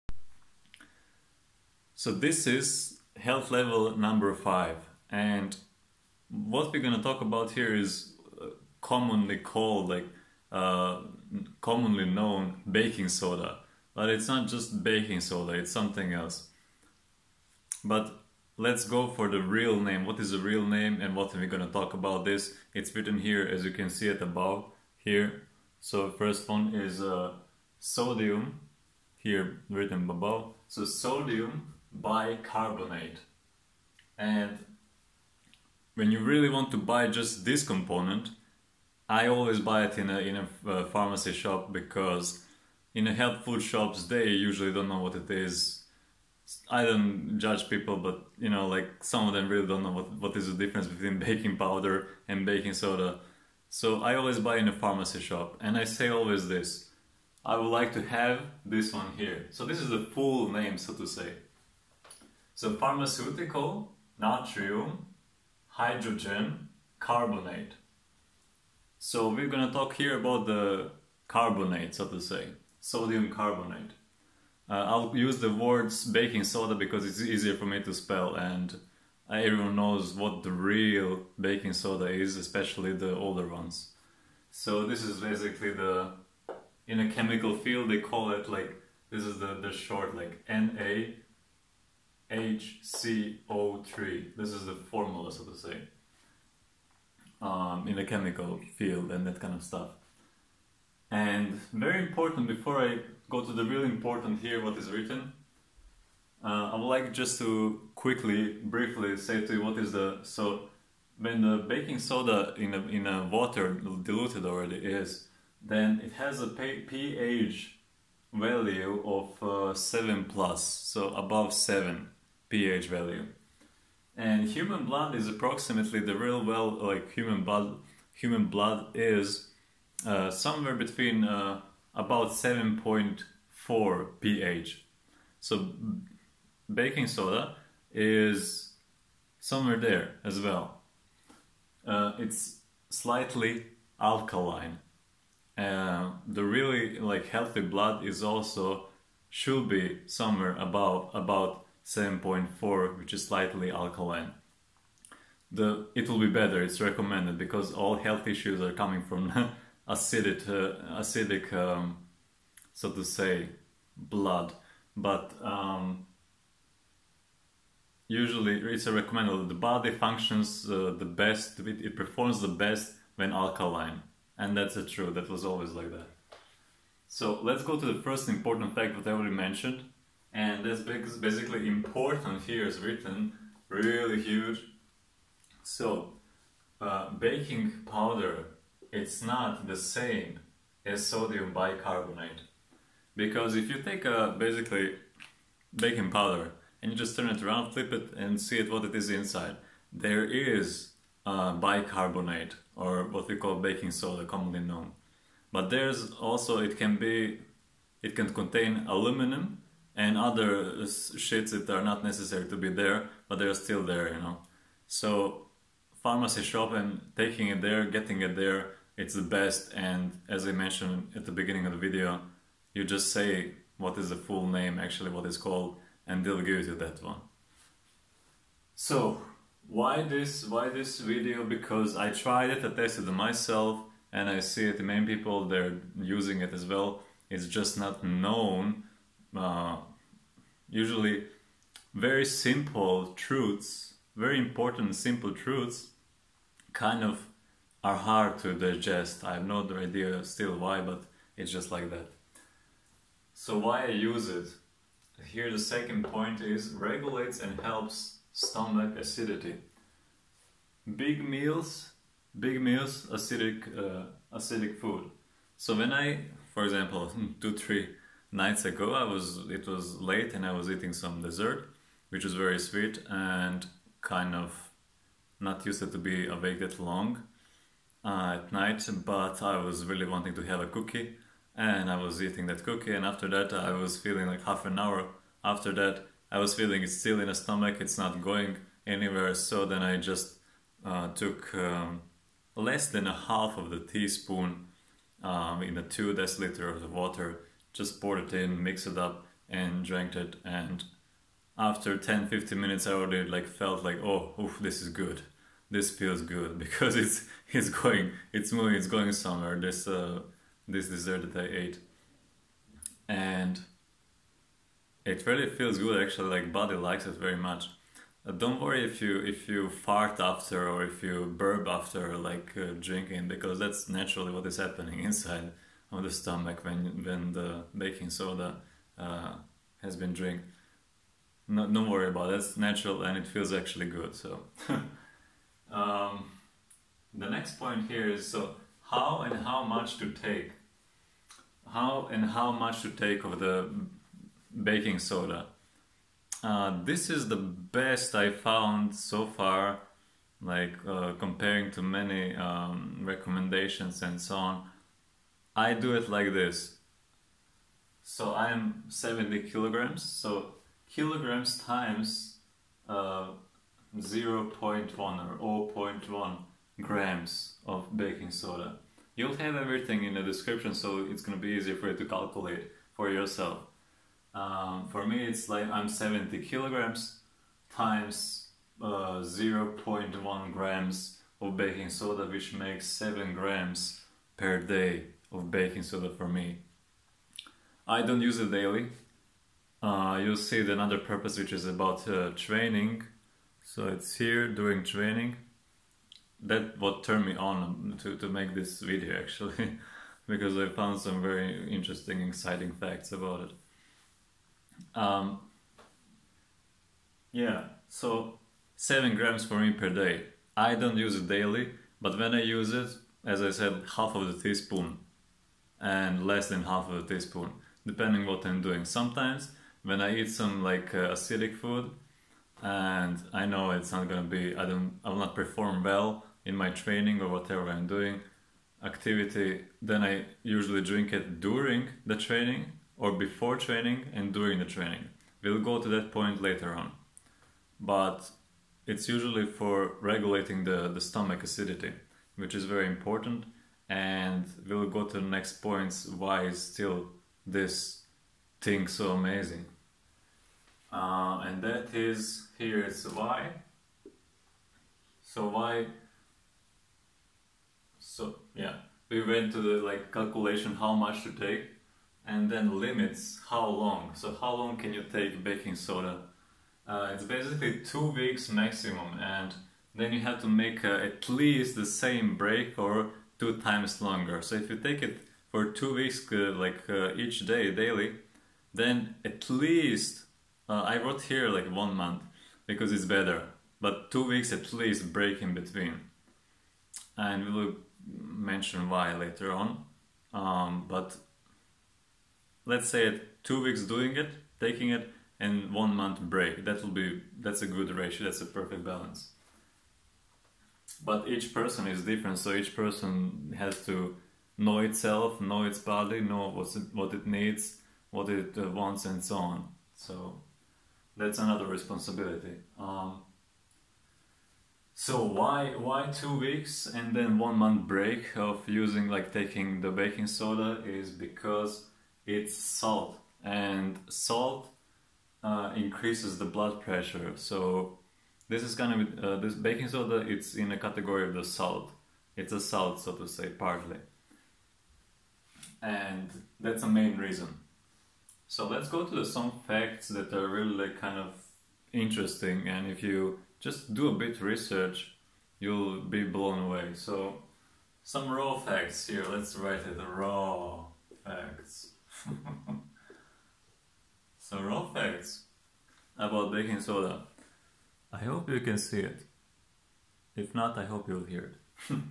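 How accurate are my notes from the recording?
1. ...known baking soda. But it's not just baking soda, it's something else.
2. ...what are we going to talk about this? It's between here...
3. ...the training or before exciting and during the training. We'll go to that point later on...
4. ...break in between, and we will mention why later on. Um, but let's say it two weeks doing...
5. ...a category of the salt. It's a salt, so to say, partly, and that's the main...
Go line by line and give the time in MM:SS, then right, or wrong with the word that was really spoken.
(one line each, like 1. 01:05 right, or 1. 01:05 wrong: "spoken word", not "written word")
1. 00:12 right
2. 00:21 wrong: "written", not "between"
3. 07:12 wrong: "training", not "exciting"
4. 08:05 right
5. 08:50 right.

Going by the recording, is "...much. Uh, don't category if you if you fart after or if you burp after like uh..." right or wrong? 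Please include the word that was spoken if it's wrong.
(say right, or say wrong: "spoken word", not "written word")
wrong: "worry", not "category".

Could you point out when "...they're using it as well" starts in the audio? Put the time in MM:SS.
03:55.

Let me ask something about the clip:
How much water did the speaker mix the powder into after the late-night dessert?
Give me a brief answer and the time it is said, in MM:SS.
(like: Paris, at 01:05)
2 deciliters, at 04:55.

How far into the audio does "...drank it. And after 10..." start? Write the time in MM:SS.
04:59.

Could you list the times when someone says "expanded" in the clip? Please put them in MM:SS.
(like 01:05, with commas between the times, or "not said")
not said.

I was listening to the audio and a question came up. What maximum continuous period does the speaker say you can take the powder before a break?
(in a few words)
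2 weeks.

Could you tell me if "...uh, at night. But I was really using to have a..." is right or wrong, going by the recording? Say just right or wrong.
wrong.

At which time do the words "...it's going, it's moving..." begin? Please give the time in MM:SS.
05:07.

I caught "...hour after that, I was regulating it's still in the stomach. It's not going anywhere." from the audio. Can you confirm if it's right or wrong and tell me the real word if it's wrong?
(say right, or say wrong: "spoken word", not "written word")
wrong: "feeling", not "regulating".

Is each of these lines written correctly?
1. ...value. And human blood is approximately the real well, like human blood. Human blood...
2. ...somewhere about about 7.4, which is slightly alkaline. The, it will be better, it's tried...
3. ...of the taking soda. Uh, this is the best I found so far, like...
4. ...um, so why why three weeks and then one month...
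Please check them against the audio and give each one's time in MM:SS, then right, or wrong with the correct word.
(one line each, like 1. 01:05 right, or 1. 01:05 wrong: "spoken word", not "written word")
1. 02:02 right
2. 02:30 wrong: "recommended", not "tried"
3. 05:43 wrong: "baking", not "taking"
4. 08:32 wrong: "two", not "three".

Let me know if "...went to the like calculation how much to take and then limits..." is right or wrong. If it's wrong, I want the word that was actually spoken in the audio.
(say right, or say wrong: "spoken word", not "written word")
right.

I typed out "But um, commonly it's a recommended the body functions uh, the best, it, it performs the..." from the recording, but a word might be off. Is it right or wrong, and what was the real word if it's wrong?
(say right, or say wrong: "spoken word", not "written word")
wrong: "usually", not "commonly".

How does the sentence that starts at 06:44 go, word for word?
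Um, yeah, so 7 grams for me per day.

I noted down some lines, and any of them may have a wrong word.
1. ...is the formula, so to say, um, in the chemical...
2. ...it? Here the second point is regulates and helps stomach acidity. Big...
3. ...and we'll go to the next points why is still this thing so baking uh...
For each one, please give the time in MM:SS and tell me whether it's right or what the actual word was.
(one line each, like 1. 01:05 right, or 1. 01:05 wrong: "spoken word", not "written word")
1. 01:34 right
2. 04:14 right
3. 07:23 wrong: "amazing", not "baking".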